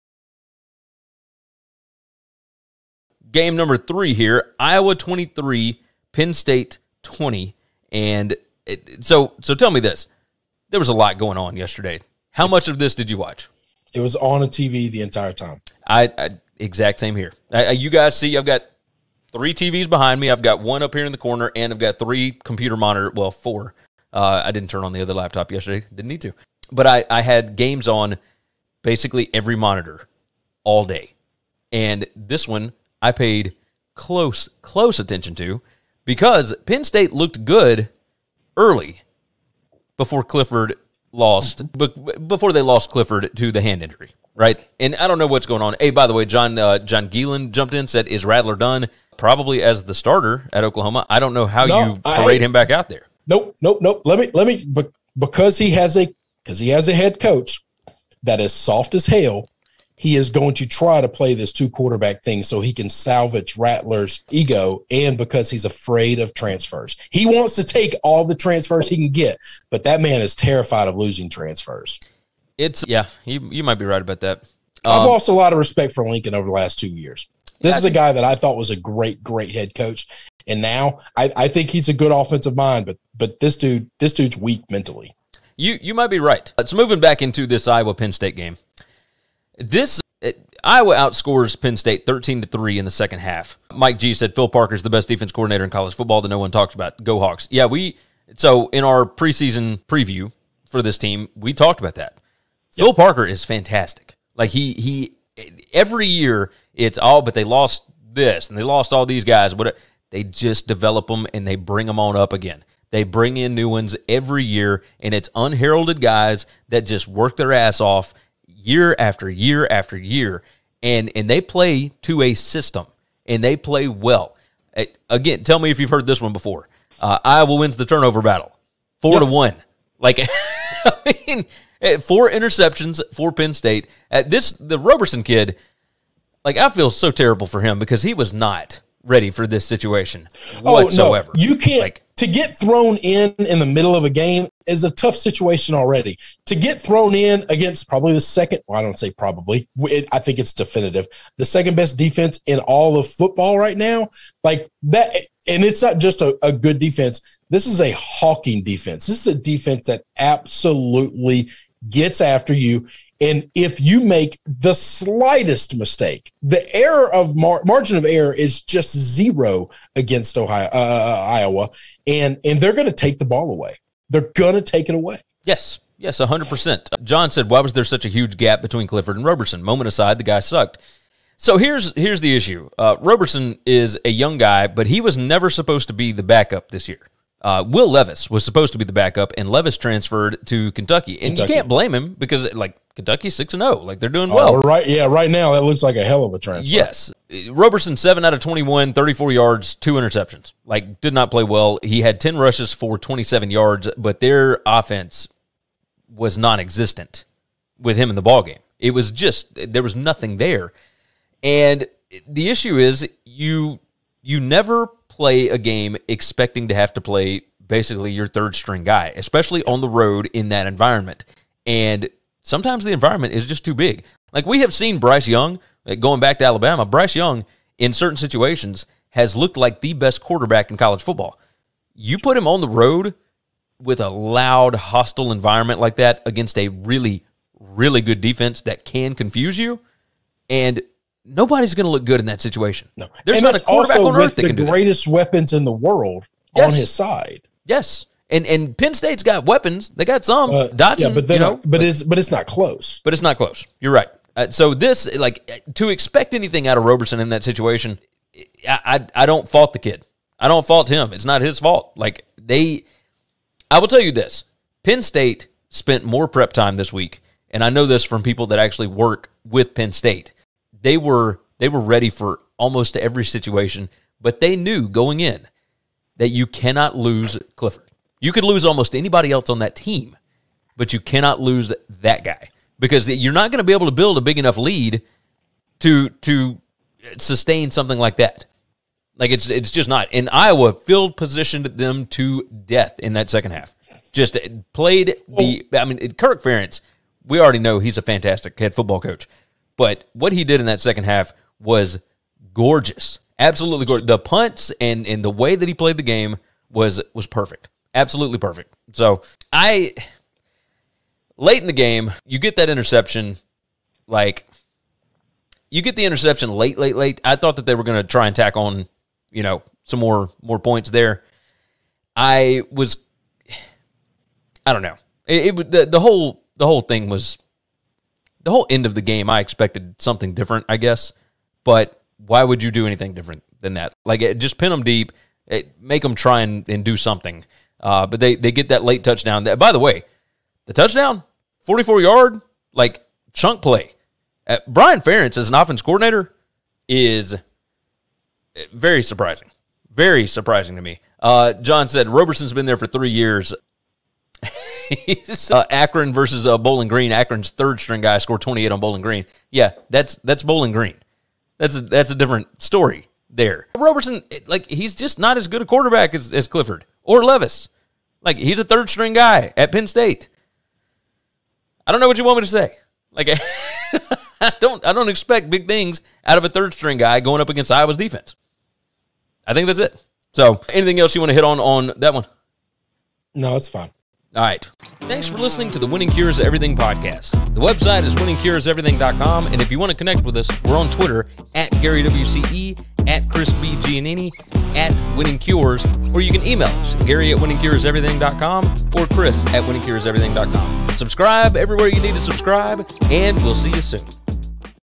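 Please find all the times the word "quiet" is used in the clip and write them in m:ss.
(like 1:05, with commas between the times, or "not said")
not said.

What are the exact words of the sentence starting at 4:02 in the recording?
No, there's and not a quarterback also on earth with that the can do greatest that.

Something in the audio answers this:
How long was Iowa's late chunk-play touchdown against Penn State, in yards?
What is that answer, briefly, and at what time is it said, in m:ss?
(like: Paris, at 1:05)
44, at 5:41.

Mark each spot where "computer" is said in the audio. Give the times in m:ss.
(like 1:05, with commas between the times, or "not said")
0:22.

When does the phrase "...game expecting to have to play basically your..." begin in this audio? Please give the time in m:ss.
3:35.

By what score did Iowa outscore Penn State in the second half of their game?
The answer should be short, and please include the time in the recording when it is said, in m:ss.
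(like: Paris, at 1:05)
13 to 3, at 1:32.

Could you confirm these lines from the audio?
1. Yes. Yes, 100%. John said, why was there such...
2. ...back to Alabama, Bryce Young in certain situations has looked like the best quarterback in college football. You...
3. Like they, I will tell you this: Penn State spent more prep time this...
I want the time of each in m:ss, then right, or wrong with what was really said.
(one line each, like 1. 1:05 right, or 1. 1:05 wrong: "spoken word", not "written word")
1. 2:55 right
2. 3:46 right
3. 4:21 right.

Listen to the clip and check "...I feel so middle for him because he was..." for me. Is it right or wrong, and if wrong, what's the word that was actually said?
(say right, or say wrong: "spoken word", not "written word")
wrong: "terrible", not "middle".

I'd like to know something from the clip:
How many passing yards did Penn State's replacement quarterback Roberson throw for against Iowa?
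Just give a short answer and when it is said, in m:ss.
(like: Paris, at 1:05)
34, at 3:18.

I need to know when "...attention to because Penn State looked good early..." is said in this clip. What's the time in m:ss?
0:34.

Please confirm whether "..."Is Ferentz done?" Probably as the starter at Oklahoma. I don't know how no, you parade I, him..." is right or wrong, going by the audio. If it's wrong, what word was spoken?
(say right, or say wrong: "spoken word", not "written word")
wrong: "Rattler", not "Ferentz".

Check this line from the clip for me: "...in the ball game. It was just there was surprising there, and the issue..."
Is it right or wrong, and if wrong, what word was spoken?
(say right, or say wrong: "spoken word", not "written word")
wrong: "nothing", not "surprising".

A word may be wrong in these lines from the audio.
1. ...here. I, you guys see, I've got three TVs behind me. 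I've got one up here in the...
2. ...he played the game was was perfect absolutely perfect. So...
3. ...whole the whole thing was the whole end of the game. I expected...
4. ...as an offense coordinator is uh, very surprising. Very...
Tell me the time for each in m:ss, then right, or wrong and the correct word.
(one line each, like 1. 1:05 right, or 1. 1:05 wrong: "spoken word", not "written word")
1. 0:17 right
2. 5:05 right
3. 5:25 right
4. 5:45 right.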